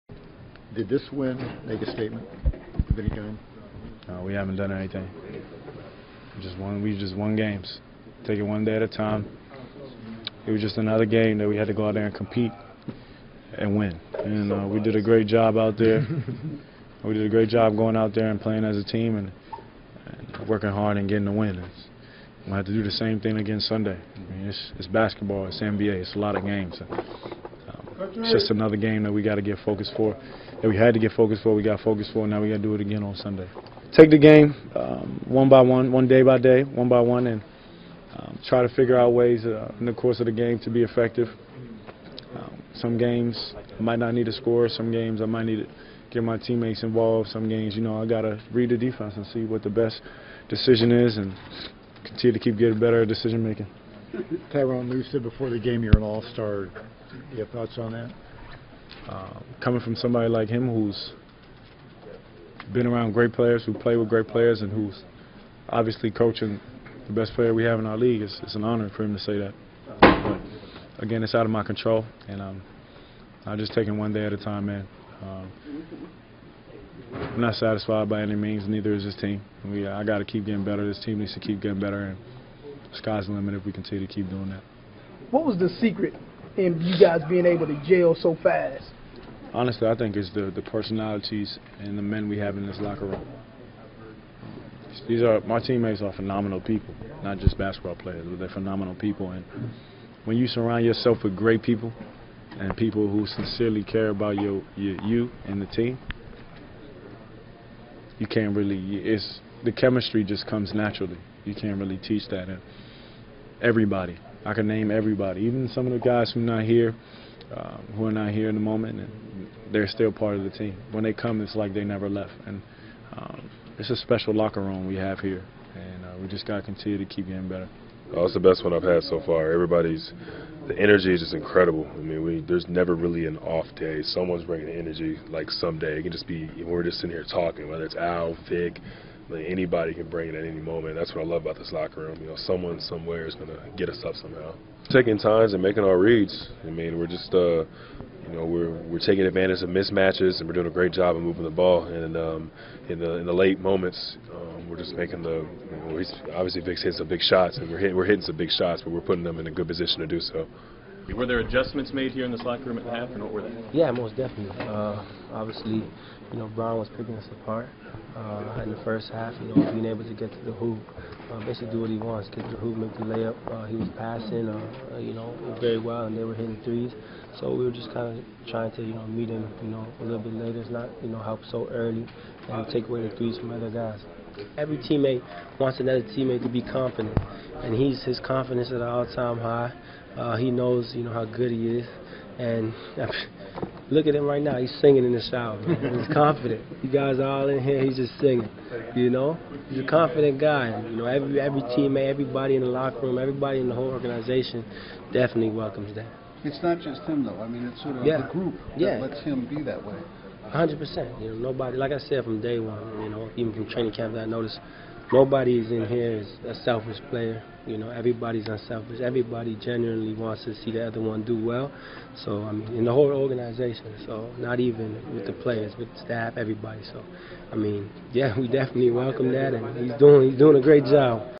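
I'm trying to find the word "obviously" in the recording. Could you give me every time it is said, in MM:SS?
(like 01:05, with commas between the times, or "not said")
01:05, 02:36, 02:45.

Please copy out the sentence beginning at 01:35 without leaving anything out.
These are my teammates are phenomenal people, not just basketball players, but they're phenomenal people.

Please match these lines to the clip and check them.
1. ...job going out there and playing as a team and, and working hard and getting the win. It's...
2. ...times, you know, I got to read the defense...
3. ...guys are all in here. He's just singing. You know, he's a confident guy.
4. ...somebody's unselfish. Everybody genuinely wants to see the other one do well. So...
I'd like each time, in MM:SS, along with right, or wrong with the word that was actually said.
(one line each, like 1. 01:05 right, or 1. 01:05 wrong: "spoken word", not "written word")
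1. 00:17 right
2. 00:47 wrong: "games", not "times"
3. 03:16 right
4. 03:37 wrong: "everybody", not "somebody".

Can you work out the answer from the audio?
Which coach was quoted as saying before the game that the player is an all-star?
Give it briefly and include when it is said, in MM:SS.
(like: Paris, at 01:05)
Tyronn Lue, at 00:54.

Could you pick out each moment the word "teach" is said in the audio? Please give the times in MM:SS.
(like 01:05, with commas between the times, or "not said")
01:51.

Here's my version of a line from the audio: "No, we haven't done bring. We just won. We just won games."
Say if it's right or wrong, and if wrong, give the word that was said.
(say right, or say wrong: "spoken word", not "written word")
wrong: "anything", not "bring".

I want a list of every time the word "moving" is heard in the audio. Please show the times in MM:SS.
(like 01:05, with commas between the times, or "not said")
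02:31.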